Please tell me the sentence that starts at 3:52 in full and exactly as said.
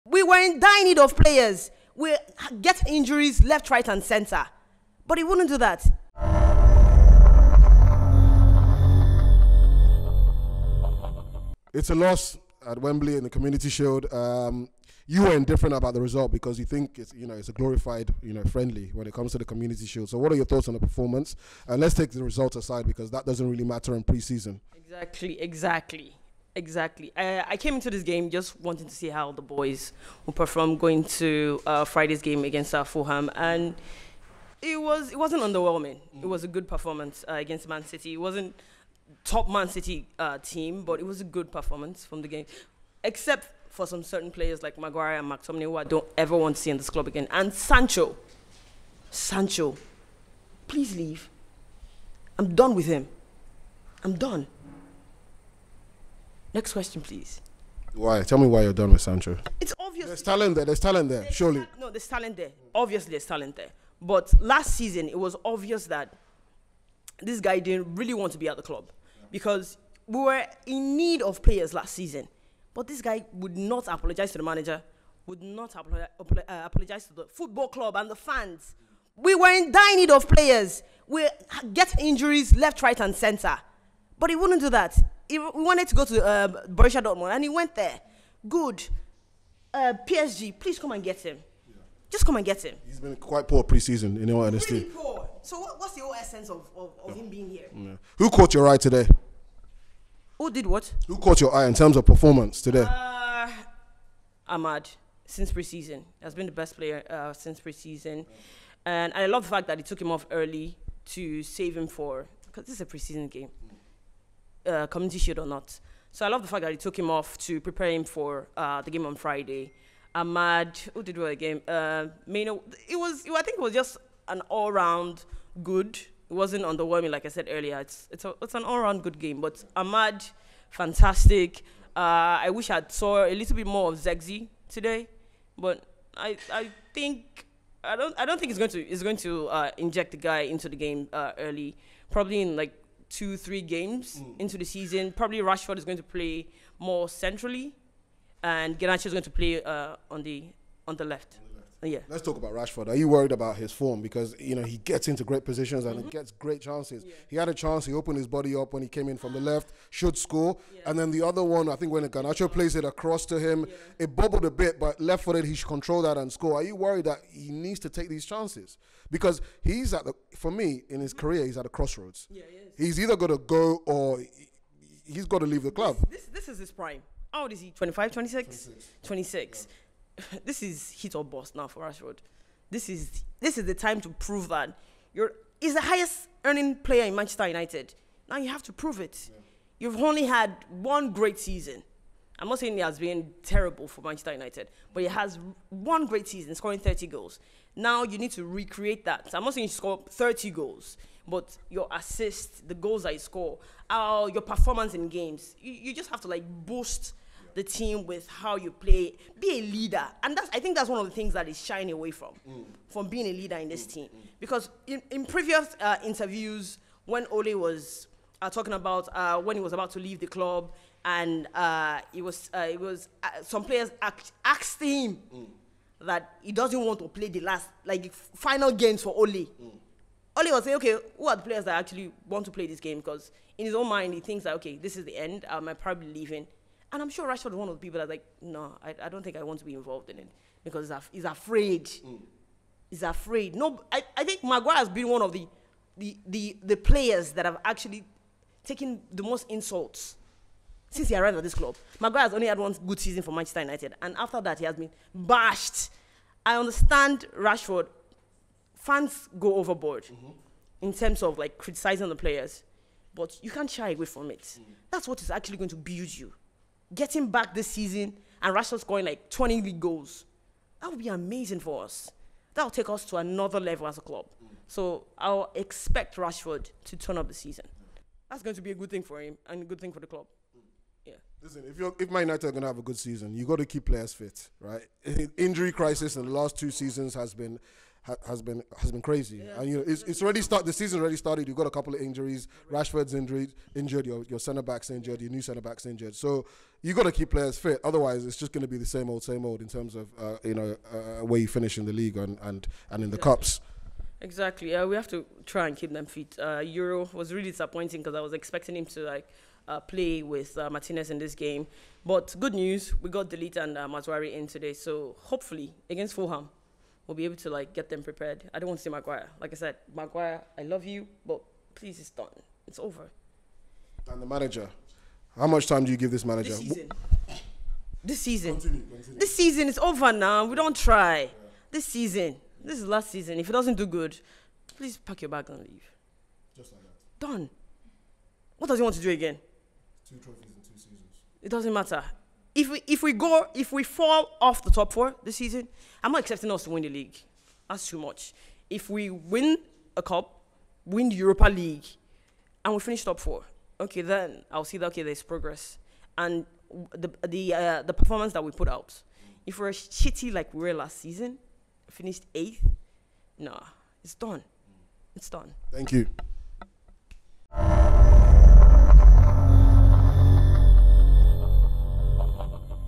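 Because in his own mind, he thinks that, okay, this is the end.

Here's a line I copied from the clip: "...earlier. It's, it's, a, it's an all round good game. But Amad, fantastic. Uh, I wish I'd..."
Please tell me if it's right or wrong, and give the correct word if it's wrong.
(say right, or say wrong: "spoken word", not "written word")
right.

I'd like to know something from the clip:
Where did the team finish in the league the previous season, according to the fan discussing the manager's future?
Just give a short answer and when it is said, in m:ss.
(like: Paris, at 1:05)
Eighth, at 6:02.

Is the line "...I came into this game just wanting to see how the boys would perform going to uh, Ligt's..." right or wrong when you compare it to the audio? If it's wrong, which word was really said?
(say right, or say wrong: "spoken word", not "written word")
wrong: "Friday", not "Ligt".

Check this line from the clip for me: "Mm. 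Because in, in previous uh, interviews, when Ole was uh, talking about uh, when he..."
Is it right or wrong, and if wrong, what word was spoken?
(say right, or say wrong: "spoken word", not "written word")
right.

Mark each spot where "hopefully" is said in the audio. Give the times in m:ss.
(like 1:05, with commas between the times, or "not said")
5:15.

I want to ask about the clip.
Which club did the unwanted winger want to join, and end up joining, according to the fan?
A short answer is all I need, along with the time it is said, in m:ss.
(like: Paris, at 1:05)
Borussia Dortmund, at 1:26.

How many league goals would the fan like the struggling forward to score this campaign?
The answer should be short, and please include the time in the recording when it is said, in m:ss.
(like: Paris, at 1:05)
20, at 4:29.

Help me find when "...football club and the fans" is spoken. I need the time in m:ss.
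1:17.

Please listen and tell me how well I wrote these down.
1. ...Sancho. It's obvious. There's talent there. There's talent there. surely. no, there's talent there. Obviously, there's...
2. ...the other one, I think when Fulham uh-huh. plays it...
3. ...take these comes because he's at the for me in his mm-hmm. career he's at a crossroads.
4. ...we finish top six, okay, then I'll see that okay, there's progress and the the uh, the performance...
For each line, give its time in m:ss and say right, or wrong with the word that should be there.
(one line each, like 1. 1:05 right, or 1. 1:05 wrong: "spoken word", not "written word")
1. 0:59 right
2. 2:41 wrong: "Garnacho", not "Fulham"
3. 2:47 wrong: "chances", not "comes"
4. 5:52 wrong: "four", not "six".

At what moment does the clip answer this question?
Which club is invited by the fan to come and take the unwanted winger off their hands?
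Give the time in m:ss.
1:30.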